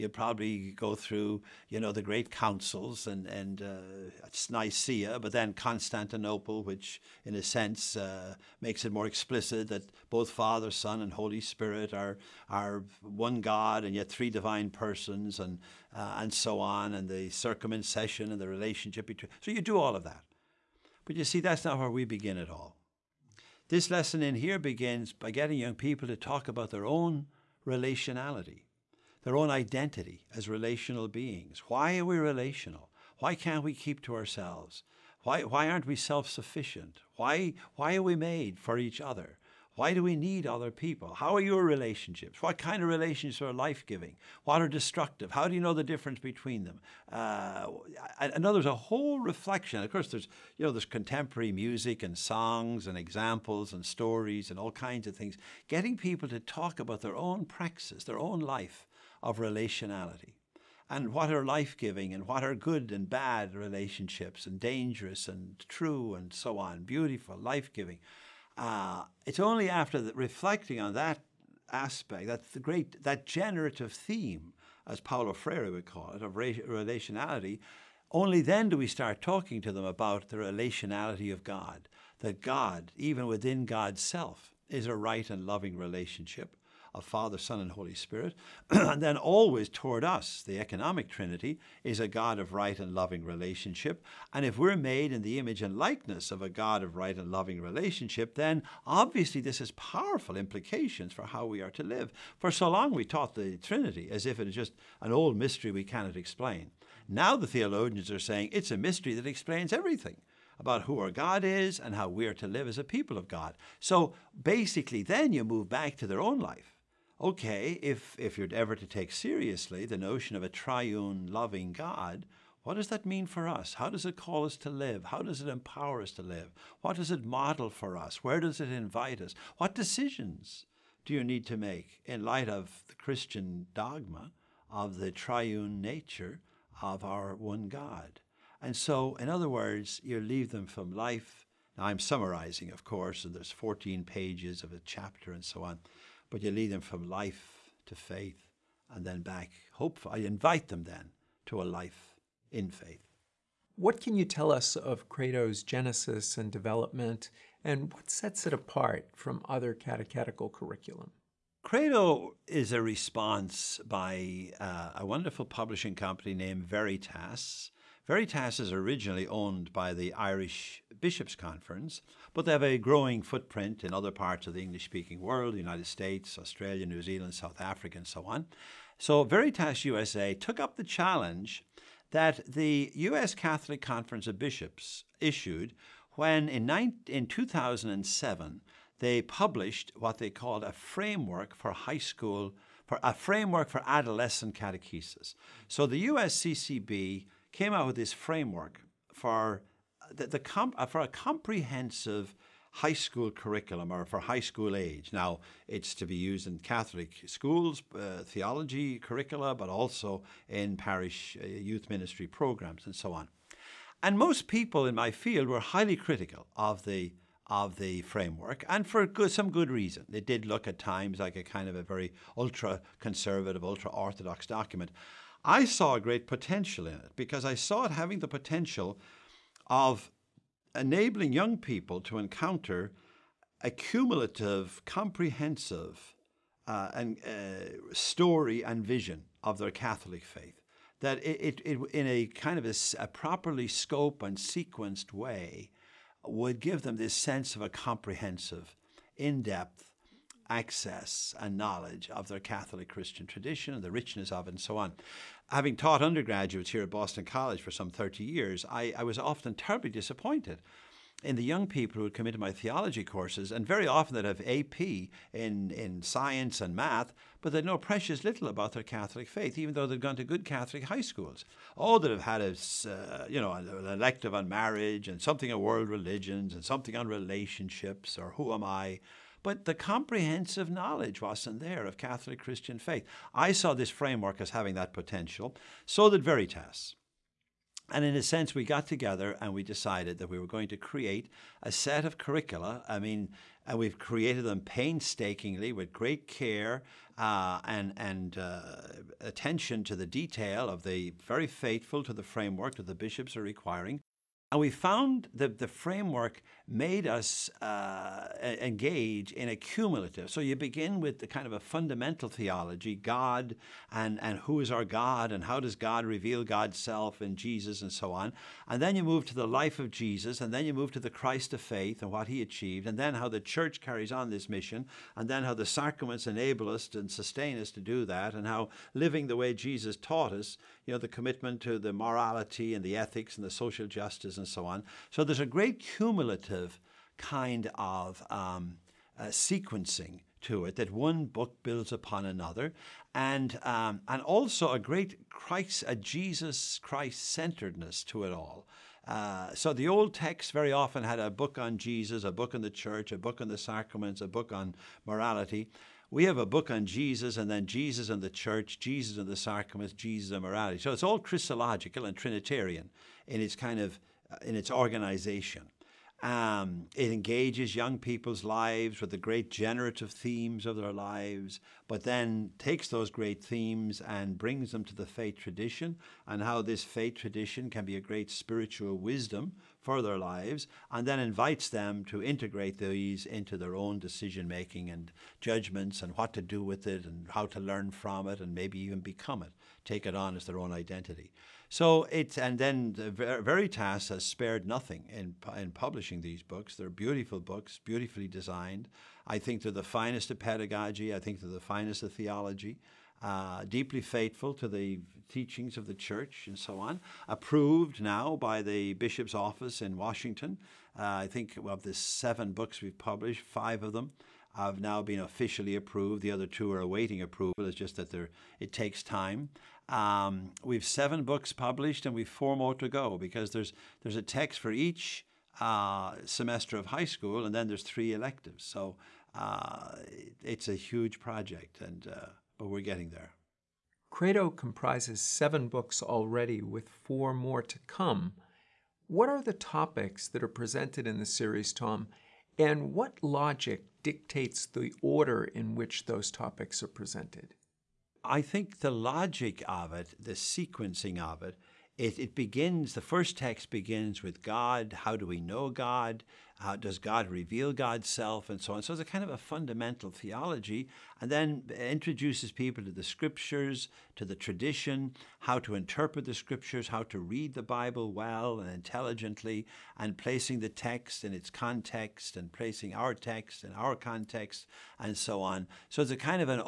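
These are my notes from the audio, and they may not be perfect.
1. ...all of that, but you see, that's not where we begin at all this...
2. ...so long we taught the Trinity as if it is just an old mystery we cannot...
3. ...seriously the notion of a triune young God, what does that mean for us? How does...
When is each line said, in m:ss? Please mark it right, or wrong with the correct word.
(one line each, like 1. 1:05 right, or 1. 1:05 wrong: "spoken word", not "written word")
1. 0:19 right
2. 1:42 right
3. 1:59 wrong: "loving", not "young".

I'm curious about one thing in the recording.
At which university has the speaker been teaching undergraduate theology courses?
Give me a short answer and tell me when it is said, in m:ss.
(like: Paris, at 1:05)
Boston College, at 4:16.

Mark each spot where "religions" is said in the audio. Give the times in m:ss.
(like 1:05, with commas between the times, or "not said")
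4:35.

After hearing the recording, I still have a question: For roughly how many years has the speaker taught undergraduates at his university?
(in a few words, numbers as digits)
30 years.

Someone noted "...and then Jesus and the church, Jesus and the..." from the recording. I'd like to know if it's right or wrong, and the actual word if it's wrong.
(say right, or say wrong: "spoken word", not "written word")
right.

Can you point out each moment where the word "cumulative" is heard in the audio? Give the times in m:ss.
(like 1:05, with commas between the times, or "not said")
3:53, 5:09, 5:35.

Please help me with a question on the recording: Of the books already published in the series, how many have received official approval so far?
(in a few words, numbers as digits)
5.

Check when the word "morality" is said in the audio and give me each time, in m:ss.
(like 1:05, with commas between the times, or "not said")
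5:31, 5:55, 6:00.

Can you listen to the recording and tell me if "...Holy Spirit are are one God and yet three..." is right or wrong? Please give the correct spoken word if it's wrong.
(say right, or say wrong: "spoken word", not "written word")
right.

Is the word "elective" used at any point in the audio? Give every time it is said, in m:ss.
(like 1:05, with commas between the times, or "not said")
4:33, 7:08.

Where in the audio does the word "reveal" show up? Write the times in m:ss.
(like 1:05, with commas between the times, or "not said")
5:16, 7:37.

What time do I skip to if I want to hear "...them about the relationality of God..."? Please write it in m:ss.
1:19.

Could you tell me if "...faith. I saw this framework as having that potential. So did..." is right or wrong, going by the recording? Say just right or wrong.
right.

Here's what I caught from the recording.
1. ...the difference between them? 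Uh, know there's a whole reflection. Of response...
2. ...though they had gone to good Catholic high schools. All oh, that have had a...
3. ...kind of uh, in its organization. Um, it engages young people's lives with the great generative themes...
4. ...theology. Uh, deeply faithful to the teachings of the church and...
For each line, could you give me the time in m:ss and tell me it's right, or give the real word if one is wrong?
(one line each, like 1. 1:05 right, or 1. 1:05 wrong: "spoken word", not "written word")
1. 0:45 wrong: "course", not "response"
2. 4:29 right
3. 6:03 right
4. 6:42 right.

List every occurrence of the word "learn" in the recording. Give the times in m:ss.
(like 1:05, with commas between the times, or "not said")
6:27.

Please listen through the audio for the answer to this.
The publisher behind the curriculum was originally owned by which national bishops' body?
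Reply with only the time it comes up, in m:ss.
2:50.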